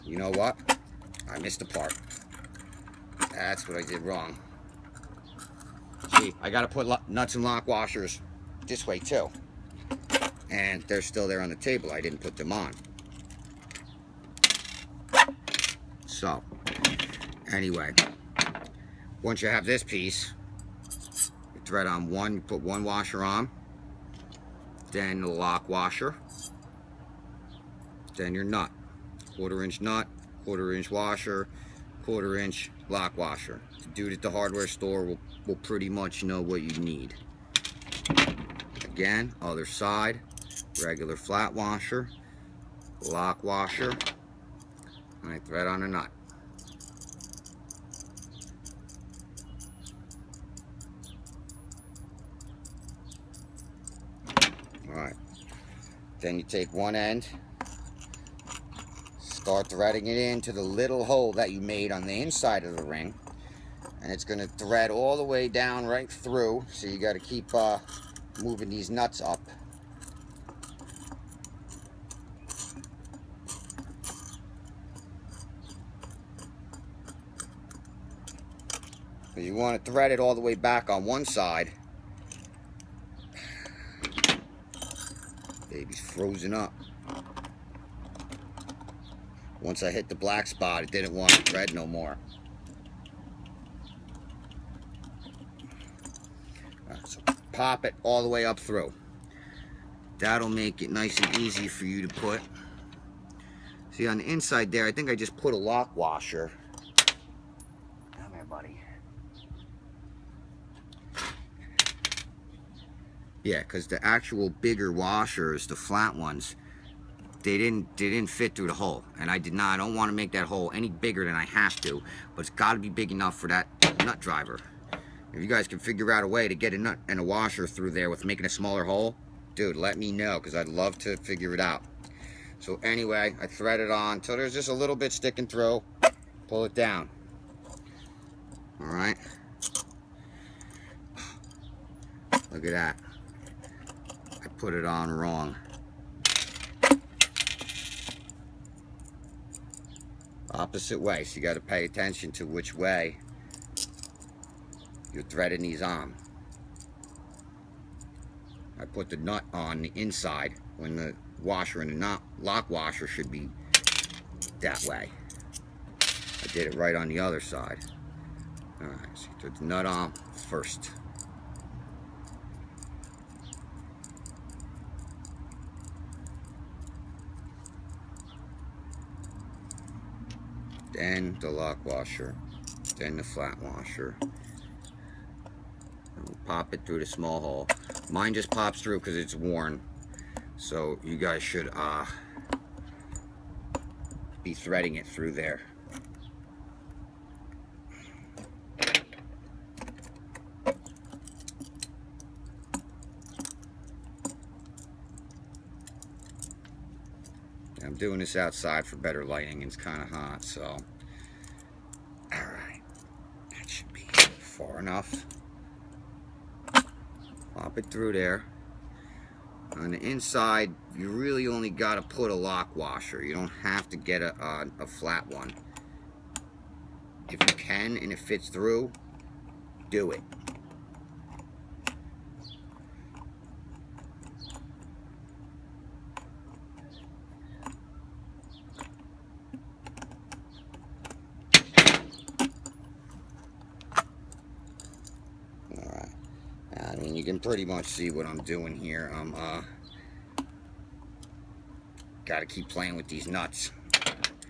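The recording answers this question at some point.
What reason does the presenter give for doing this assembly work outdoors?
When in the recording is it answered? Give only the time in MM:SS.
03:28.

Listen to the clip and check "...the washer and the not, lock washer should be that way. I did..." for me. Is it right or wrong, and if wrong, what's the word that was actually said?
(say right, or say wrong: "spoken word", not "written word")
right.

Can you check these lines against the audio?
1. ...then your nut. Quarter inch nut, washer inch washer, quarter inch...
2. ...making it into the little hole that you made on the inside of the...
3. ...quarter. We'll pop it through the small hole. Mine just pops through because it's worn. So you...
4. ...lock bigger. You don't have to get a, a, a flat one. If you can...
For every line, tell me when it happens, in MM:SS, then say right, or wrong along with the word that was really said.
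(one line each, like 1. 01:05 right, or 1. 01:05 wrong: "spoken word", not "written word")
1. 00:28 wrong: "quarter", not "washer"
2. 00:59 wrong: "threading", not "making"
3. 03:03 wrong: "washer", not "quarter"
4. 03:42 wrong: "washer", not "bigger".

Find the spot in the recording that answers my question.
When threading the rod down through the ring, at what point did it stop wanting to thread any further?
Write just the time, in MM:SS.
01:30.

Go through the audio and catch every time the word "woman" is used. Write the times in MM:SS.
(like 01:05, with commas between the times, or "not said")
not said.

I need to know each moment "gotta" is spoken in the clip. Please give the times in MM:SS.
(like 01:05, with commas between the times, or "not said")
00:06, 04:12.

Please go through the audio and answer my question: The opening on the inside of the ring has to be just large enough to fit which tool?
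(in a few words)
nut driver.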